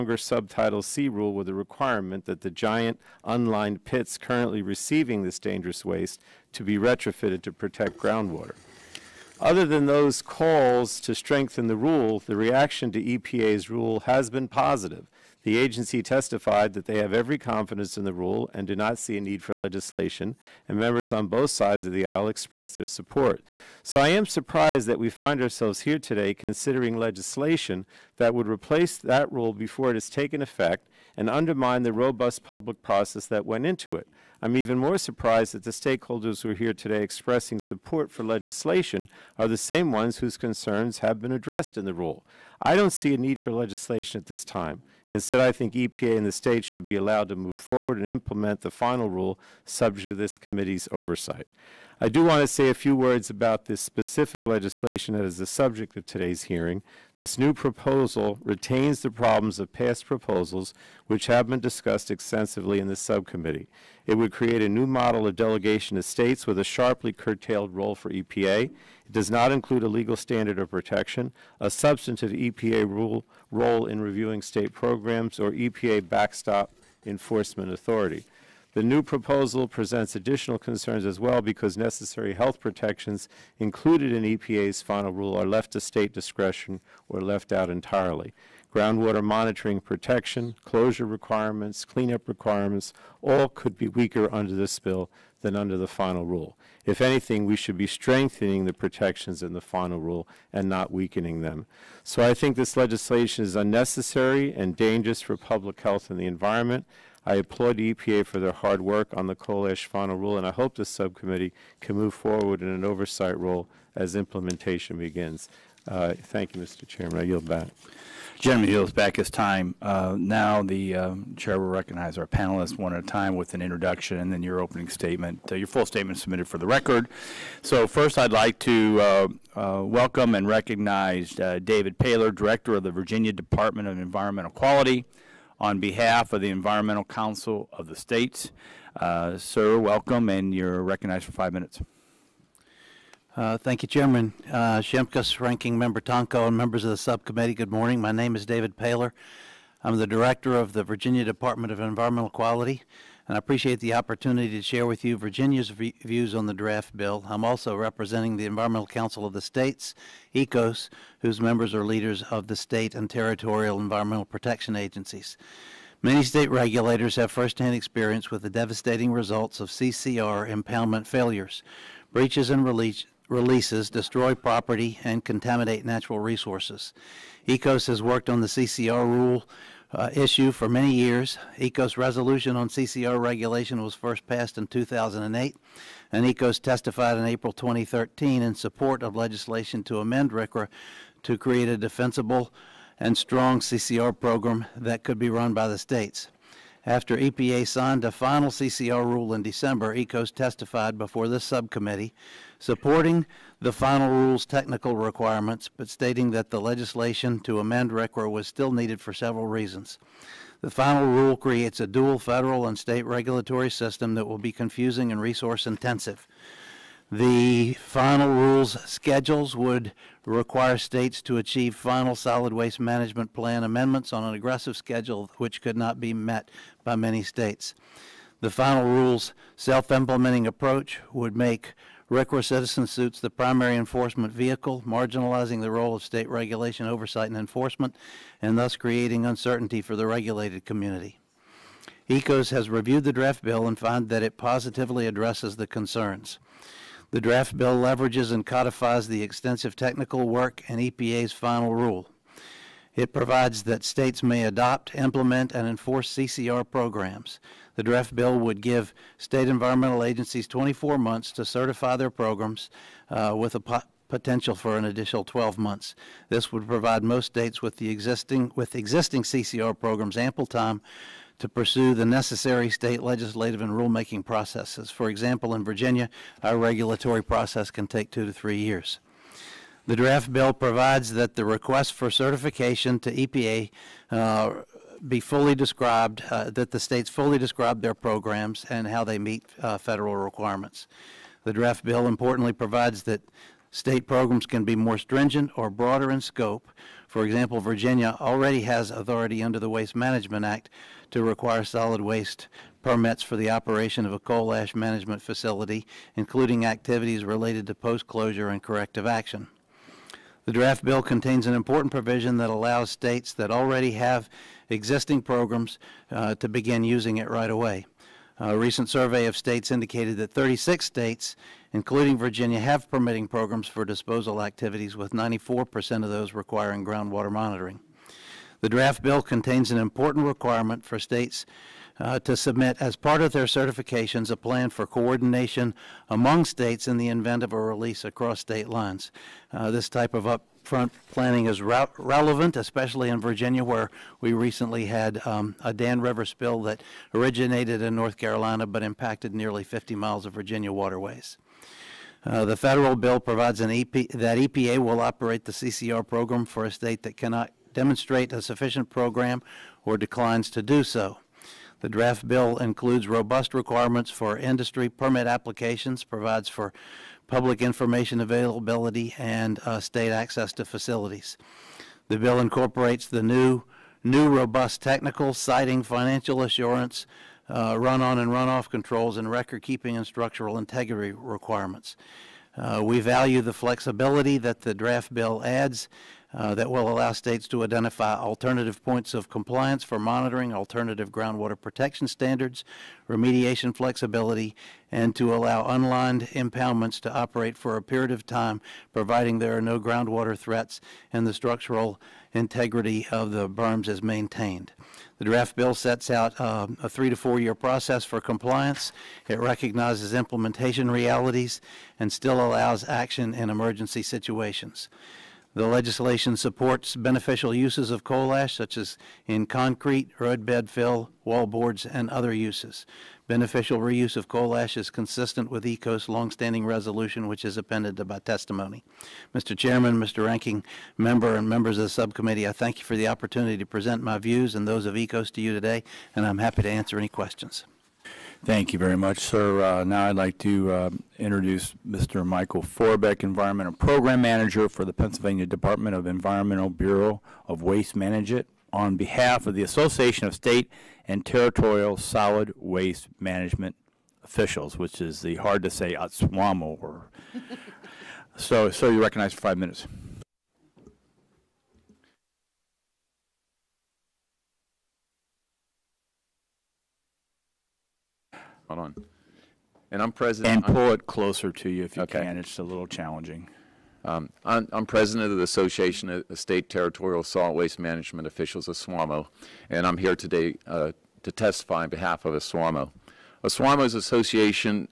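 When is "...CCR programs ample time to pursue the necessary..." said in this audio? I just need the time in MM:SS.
04:29.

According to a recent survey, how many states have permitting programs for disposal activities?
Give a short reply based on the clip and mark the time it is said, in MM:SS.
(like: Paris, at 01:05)
36, at 05:20.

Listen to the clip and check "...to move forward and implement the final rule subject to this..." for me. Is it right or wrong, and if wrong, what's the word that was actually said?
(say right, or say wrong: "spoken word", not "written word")
right.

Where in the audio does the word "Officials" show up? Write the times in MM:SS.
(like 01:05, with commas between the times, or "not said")
07:34, 07:58.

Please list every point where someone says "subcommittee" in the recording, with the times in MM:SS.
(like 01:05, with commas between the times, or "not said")
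01:02, 01:50, 02:26, 03:21, 07:11.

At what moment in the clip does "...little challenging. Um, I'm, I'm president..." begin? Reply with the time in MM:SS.
07:52.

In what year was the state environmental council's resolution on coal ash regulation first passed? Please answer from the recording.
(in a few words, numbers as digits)
2008.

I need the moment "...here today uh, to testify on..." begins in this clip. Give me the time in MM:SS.
07:59.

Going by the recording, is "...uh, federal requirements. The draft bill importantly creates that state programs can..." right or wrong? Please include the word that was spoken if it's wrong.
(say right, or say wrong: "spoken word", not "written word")
wrong: "provides", not "creates".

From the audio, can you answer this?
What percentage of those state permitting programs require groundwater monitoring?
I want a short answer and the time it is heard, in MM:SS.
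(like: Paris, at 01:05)
94%, at 05:25.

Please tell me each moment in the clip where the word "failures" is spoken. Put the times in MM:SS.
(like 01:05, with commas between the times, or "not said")
02:51.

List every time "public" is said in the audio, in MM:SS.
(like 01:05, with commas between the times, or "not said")
00:32, 01:45, 06:07.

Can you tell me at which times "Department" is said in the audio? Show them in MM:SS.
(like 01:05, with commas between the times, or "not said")
02:13, 02:31, 07:25.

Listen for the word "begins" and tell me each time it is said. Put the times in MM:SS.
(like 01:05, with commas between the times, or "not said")
01:54, 05:16.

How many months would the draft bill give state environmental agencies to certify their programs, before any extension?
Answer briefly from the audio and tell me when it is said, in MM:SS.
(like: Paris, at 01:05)
24, at 04:20.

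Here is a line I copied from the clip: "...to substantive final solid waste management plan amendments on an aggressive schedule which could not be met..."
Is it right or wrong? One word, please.
wrong.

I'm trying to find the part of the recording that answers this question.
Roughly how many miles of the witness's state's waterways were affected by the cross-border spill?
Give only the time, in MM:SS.
05:49.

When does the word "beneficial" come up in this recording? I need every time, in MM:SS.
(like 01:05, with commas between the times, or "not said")
06:56, 07:03.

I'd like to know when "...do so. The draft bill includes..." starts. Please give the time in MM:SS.
06:00.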